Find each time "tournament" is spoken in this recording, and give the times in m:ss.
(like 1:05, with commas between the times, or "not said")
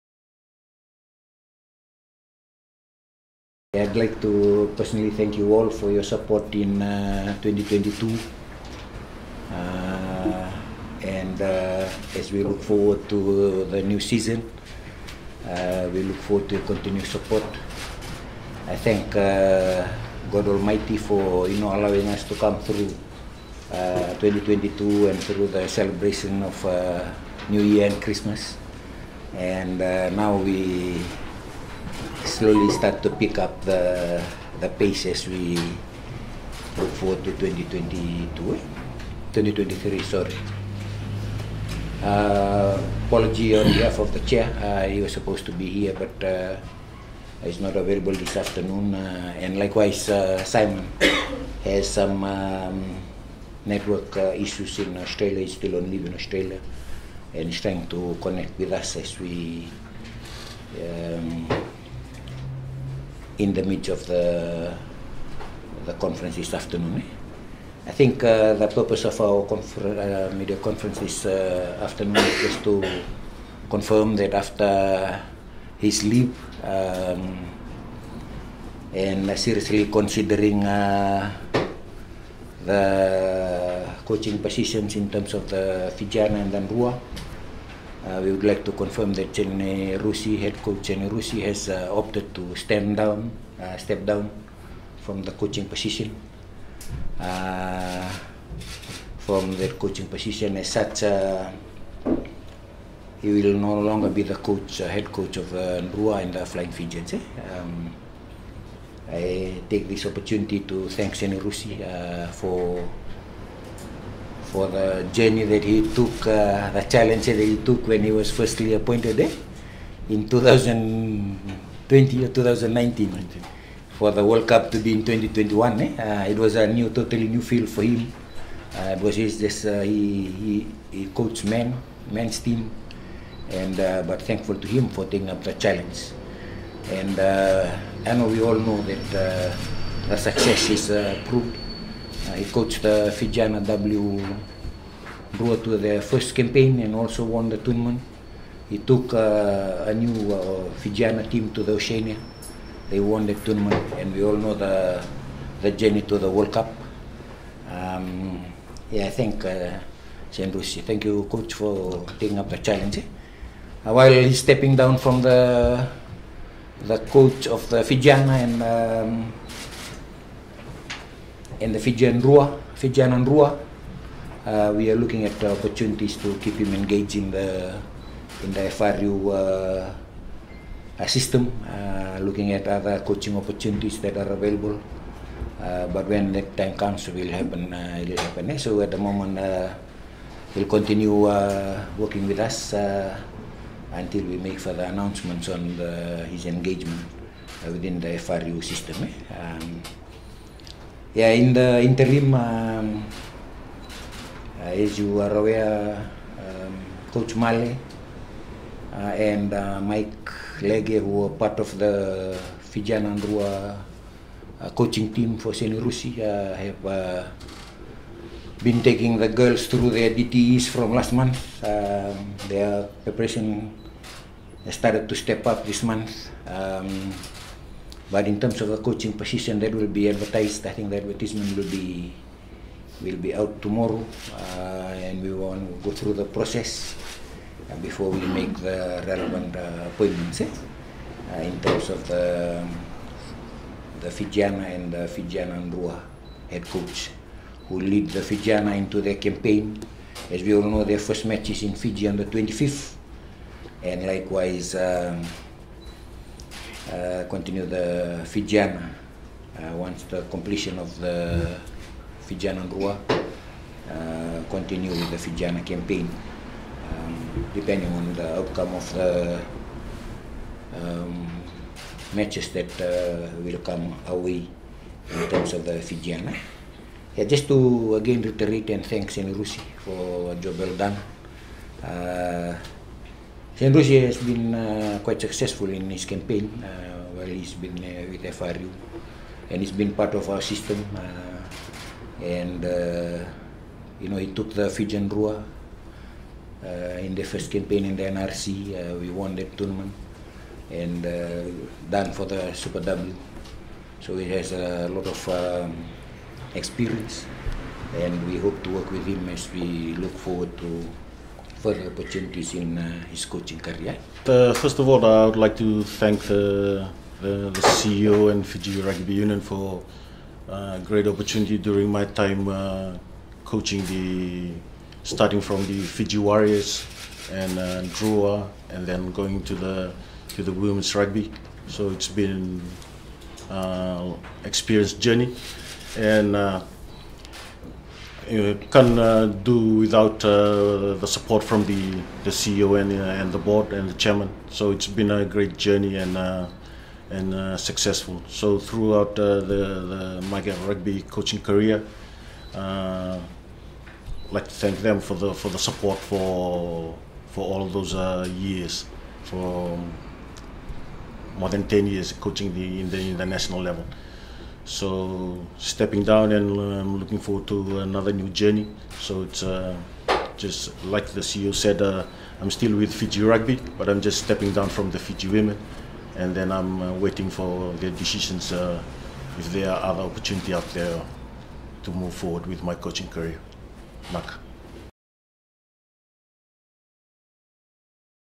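2:27, 2:33, 4:59.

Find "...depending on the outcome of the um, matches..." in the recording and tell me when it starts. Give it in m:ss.
4:27.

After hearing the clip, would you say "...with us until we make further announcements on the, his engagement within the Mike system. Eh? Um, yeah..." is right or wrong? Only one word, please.
wrong.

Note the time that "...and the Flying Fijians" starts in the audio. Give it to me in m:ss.
1:46.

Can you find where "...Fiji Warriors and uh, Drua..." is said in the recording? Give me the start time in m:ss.
5:25.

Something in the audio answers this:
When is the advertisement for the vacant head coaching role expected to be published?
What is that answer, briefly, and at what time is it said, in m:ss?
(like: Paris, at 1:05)
Tomorrow, at 3:53.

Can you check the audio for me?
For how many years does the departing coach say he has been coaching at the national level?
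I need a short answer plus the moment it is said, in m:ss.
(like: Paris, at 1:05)
More than 10 years, at 6:01.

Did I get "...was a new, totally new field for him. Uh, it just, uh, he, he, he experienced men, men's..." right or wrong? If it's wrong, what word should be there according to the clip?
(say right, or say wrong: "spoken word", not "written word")
wrong: "coached", not "experienced".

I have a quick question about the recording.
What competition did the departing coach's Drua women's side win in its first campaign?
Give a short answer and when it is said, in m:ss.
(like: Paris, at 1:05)
NRC, at 4:58.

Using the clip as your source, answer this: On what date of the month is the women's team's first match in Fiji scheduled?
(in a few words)
25th.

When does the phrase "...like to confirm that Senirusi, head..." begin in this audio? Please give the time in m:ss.
1:28.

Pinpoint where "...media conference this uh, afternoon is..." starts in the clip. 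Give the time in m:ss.
1:10.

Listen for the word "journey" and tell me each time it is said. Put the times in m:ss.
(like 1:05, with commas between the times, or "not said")
1:55, 2:35, 5:34, 5:45, 6:08.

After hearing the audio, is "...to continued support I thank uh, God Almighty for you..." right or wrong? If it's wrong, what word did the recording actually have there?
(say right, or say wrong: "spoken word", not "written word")
right.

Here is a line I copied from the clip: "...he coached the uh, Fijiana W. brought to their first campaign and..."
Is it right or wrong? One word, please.
right.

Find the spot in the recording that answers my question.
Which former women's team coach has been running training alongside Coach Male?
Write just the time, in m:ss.
3:29.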